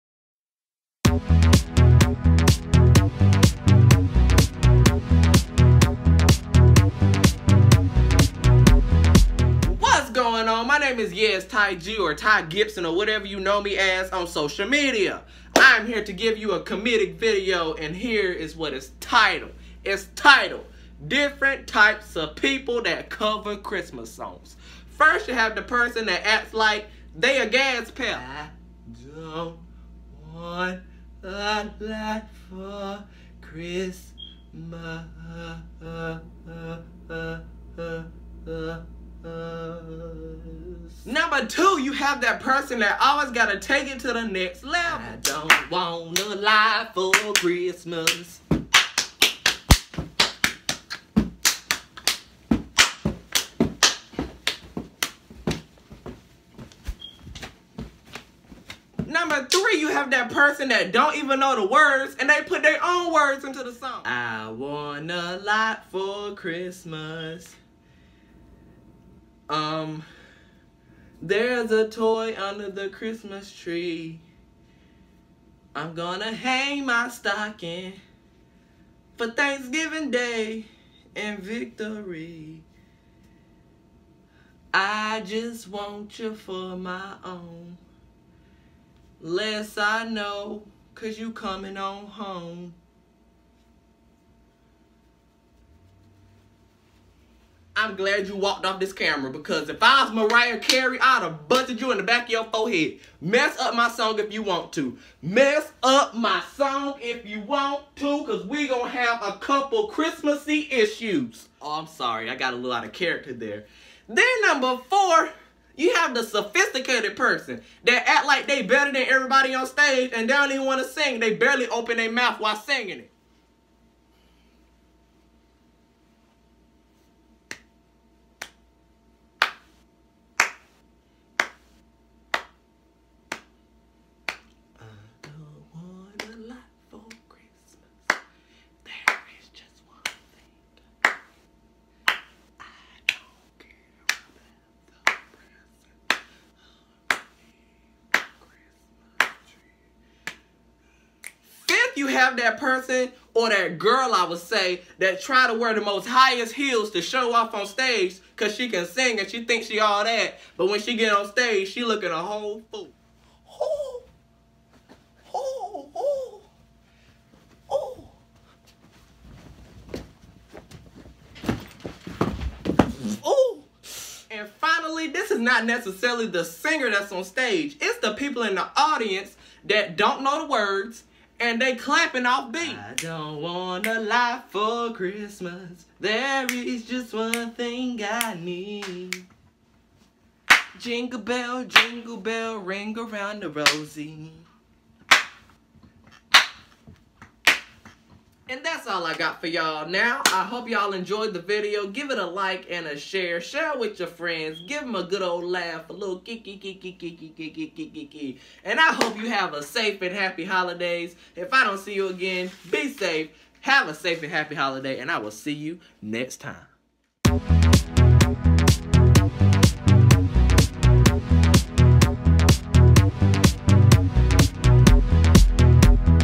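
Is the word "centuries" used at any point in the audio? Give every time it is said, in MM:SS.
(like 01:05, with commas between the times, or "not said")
not said.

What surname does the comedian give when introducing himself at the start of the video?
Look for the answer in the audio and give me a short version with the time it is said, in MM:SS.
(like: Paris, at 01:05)
Gibson, at 00:12.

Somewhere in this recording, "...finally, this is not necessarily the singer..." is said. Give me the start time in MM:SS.
02:54.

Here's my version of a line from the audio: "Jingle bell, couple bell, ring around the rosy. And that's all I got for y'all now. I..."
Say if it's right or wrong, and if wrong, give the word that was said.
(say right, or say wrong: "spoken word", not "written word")
wrong: "jingle", not "couple".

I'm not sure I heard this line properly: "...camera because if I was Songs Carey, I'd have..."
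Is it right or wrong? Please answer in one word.
wrong.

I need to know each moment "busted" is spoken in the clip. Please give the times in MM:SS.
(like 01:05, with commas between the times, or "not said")
01:41.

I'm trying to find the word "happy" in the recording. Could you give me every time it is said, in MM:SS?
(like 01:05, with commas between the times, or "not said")
03:30, 03:34.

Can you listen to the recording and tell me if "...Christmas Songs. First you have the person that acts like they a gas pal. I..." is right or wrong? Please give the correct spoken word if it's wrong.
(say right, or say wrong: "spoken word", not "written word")
right.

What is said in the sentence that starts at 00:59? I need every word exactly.
Number three, you have that person that don't even know the words and they put their own words into the song.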